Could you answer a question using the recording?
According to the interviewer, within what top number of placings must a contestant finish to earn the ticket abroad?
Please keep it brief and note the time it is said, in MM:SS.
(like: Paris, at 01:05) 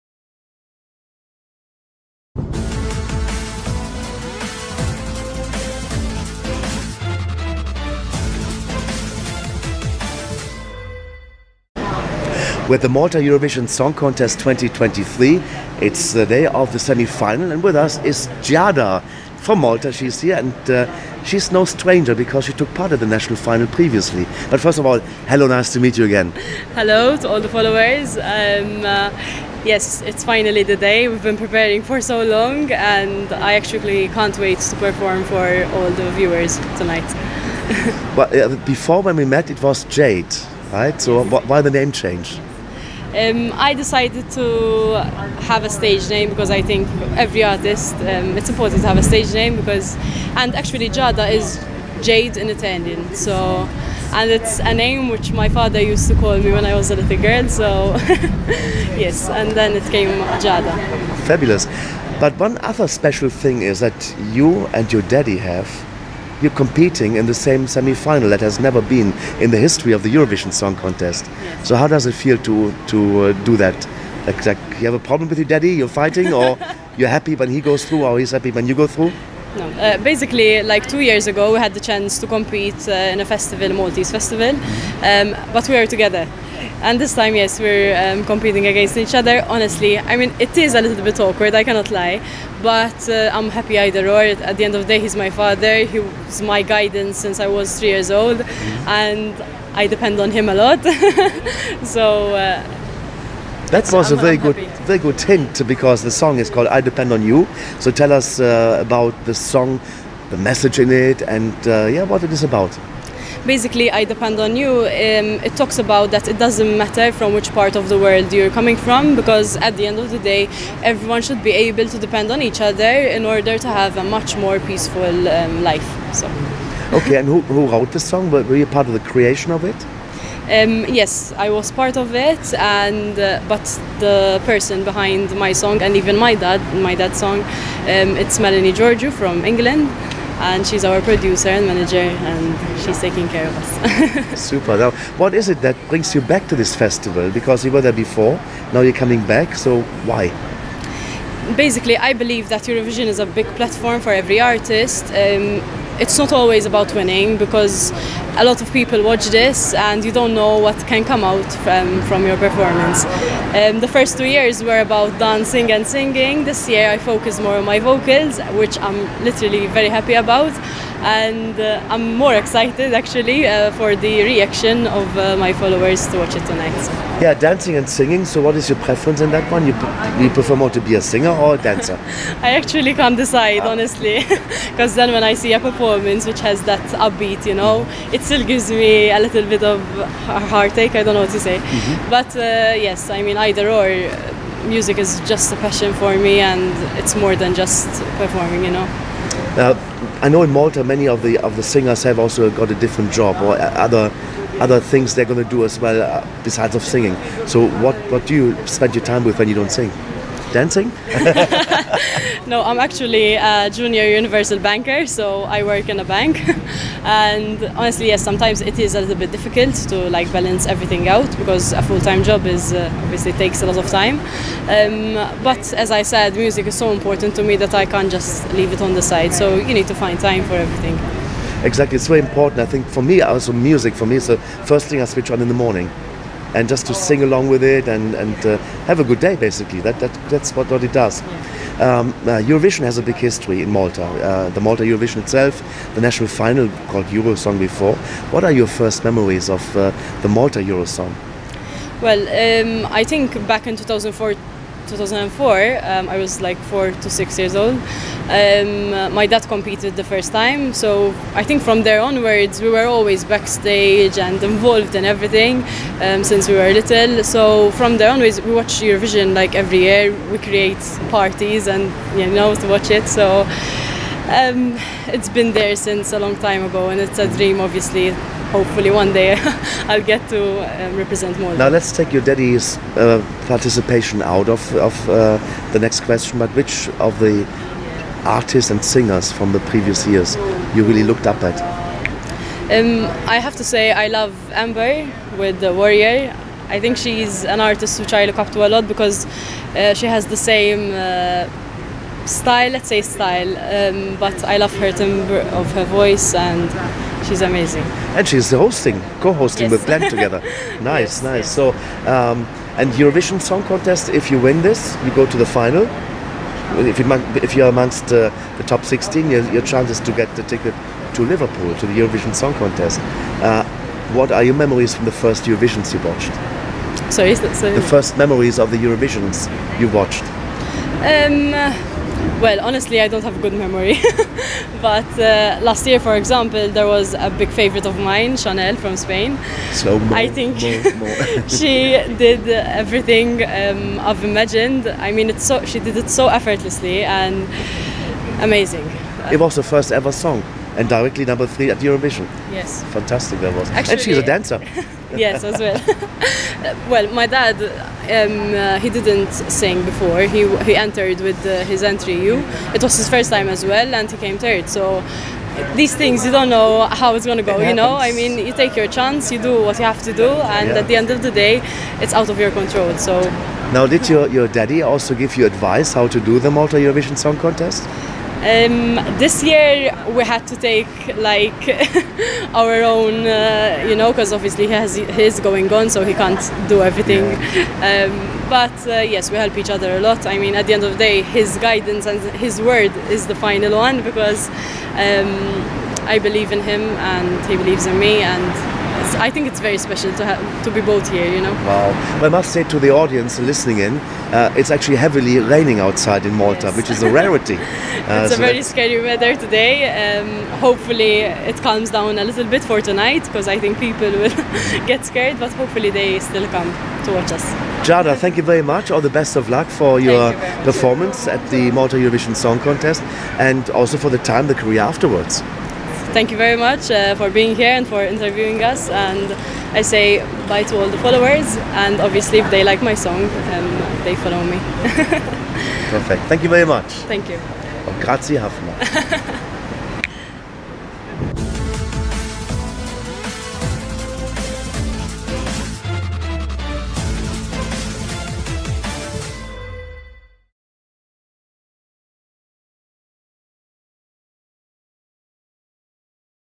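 16, at 05:18.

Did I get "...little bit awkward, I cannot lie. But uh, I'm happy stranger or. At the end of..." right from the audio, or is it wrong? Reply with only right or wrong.
wrong.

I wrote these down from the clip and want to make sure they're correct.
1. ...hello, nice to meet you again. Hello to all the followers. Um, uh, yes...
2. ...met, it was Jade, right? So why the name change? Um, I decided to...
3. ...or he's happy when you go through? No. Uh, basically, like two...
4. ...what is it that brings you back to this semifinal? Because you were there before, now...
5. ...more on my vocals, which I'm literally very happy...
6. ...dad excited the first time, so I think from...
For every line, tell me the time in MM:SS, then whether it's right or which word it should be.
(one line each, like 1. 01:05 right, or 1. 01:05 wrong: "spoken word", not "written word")
1. 00:25 right
2. 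00:39 right
3. 01:18 right
4. 02:25 wrong: "festival", not "semifinal"
5. 02:47 right
6. 04:19 wrong: "competed", not "excited".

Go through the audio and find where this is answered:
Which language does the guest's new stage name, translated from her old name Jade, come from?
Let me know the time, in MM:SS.
00:52.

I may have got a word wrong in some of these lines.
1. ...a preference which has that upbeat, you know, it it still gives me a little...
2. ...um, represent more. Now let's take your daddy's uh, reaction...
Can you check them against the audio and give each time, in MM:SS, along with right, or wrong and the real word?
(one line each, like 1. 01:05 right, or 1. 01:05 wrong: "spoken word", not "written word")
1. 03:05 wrong: "performance", not "preference"
2. 04:40 wrong: "participation", not "reaction".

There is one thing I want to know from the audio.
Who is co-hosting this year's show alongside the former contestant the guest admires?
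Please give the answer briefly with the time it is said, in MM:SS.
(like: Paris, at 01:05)
Glenn, at 05:09.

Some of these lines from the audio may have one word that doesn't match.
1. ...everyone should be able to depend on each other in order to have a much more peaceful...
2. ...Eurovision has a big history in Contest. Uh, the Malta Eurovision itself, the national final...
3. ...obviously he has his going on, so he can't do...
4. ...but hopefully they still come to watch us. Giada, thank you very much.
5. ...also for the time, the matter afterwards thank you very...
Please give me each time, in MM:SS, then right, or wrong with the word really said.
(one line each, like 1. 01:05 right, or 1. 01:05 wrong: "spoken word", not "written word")
1. 02:00 right
2. 04:02 wrong: "Malta", not "Contest"
3. 06:24 right
4. 06:55 right
5. 07:03 wrong: "career", not "matter".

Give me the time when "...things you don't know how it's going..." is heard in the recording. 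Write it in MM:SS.
06:05.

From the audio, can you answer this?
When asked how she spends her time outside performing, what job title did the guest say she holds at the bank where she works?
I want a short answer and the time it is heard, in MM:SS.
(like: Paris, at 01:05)
Junior universal banker, at 03:33.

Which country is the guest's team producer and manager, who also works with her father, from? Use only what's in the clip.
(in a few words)
England.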